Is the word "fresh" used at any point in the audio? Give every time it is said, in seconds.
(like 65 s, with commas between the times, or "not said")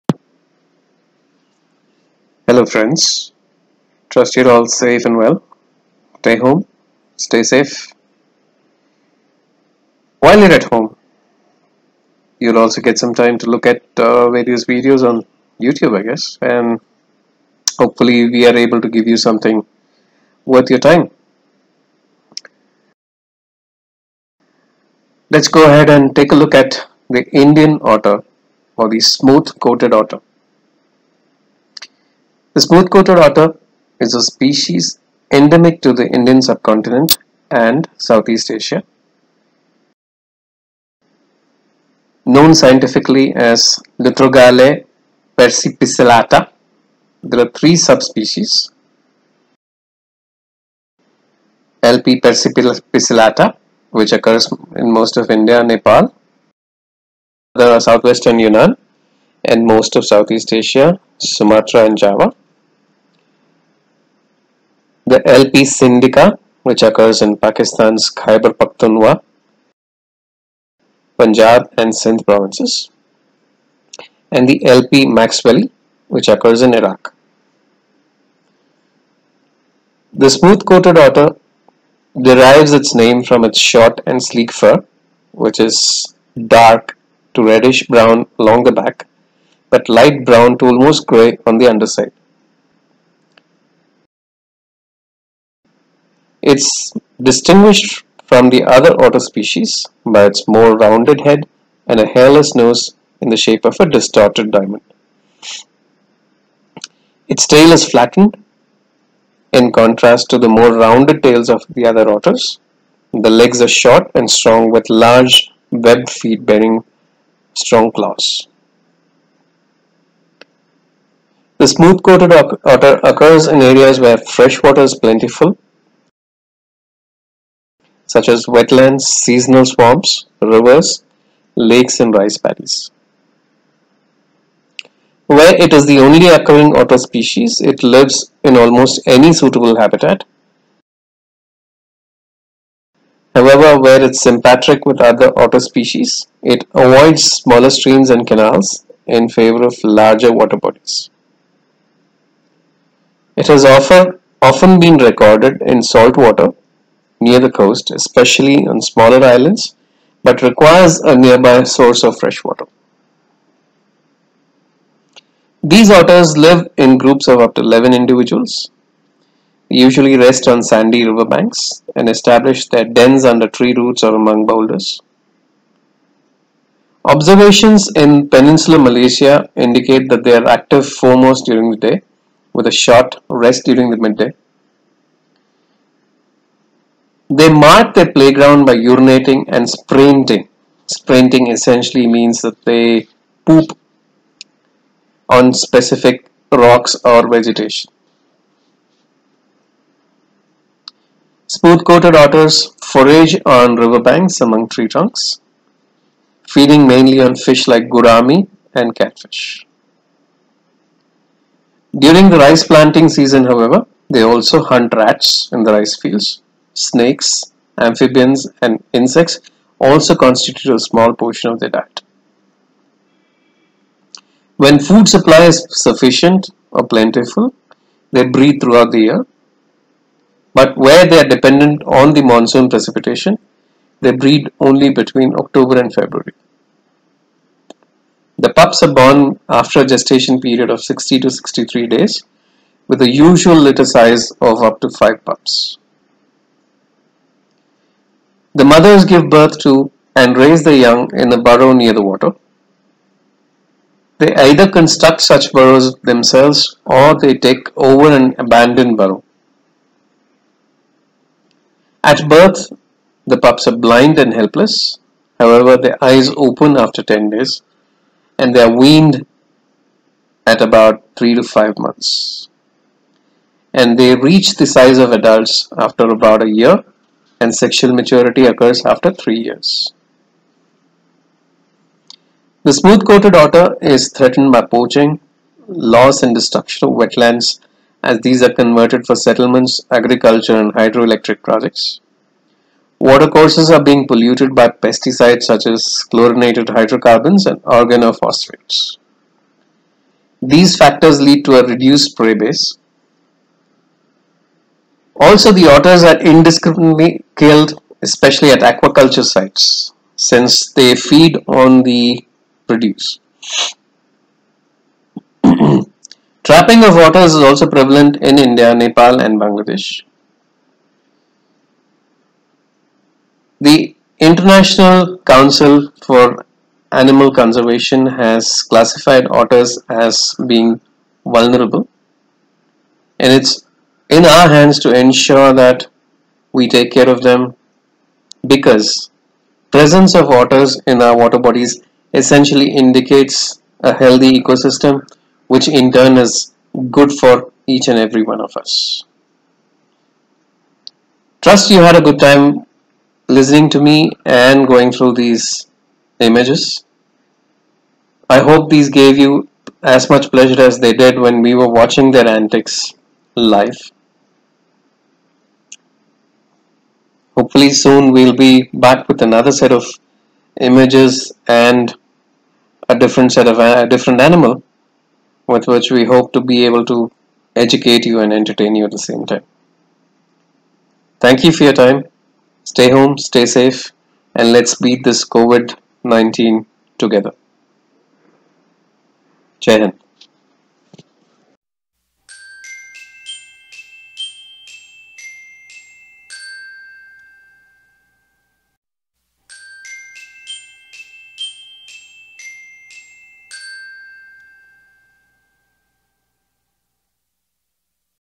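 124 s, 162 s.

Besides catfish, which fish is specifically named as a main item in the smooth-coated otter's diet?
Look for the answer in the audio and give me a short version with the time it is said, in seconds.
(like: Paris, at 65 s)
gourami, at 207 s.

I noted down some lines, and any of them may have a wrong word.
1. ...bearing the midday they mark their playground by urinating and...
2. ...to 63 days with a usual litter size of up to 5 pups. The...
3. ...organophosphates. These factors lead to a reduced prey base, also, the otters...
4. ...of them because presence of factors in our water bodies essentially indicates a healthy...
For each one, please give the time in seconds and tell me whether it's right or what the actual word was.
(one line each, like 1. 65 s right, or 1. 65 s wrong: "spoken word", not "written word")
1. 183 s wrong: "during", not "bearing"
2. 241 s right
3. 297 s right
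4. 337 s wrong: "otters", not "factors".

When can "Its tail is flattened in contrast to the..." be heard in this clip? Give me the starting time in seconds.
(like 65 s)
107 s.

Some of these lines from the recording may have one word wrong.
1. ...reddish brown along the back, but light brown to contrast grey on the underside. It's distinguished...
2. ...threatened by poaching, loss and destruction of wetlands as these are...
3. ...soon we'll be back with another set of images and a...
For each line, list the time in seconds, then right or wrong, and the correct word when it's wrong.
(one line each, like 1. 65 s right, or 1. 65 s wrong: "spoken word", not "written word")
1. 87 s wrong: "almost", not "contrast"
2. 284 s right
3. 367 s right.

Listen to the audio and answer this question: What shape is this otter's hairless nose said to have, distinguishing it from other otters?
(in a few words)
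distorted diamond.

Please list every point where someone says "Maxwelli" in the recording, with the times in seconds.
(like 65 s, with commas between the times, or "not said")
75 s.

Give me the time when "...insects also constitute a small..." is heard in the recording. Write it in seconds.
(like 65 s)
218 s.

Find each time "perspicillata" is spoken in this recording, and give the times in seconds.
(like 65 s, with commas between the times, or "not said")
45 s, 52 s.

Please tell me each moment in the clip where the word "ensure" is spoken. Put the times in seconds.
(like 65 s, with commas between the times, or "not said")
334 s.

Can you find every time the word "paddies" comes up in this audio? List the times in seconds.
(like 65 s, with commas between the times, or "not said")
132 s.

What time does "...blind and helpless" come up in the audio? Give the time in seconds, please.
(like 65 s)
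263 s.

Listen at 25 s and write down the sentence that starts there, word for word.
Let's go ahead and take a look at the Indian otter or the smooth coated otter.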